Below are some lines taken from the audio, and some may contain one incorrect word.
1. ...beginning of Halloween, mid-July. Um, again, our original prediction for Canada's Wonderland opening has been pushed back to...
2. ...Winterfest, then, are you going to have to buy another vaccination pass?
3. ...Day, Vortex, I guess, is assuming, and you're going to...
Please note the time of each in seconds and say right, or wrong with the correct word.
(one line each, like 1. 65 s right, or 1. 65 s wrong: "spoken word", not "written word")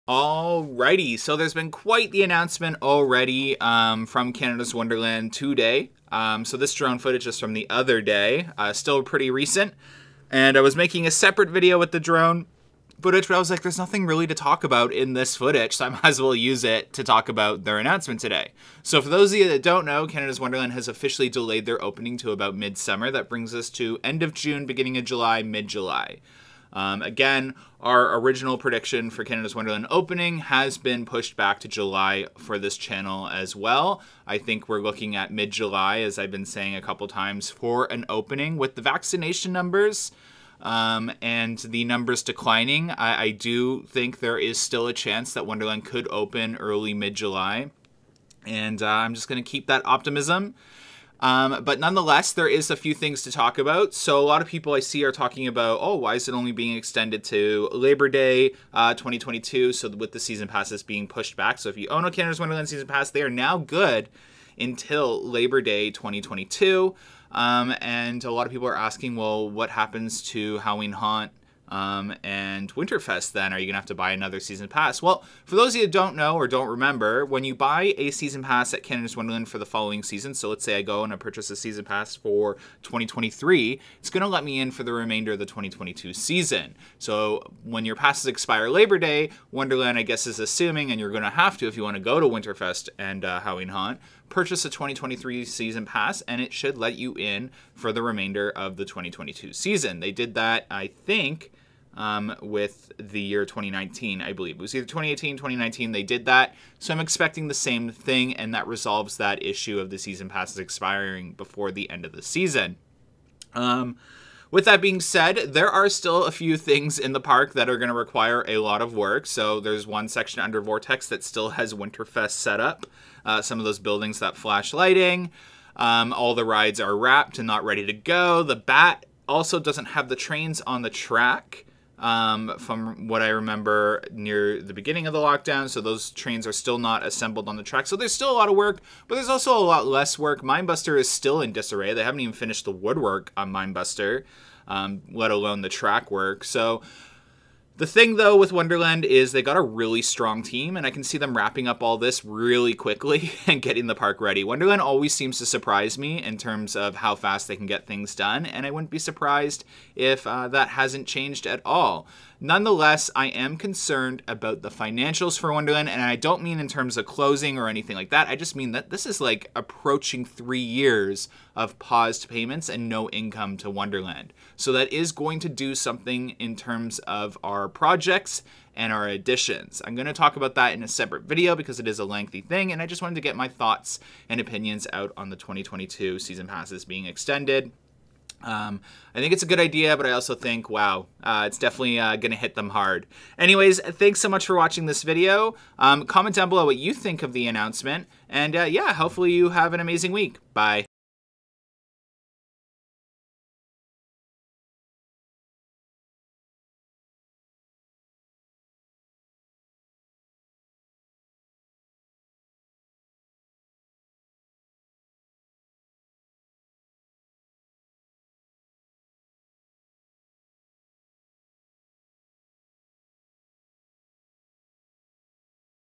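1. 24 s wrong: "July", not "Halloween"
2. 72 s wrong: "season", not "vaccination"
3. 88 s wrong: "Wonderland", not "Vortex".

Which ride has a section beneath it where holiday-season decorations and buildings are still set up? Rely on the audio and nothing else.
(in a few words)
Vortex.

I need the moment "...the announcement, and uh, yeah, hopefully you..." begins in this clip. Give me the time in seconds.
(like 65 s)
197 s.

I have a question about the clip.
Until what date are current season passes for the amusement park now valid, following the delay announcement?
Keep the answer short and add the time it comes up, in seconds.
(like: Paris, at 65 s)
Labor Day 2022, at 65 s.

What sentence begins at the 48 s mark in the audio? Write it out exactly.
And uh, I'm just going to keep that optimism.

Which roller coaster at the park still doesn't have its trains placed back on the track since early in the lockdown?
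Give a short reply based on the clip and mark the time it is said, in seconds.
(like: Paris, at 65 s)
The Bat, at 128 s.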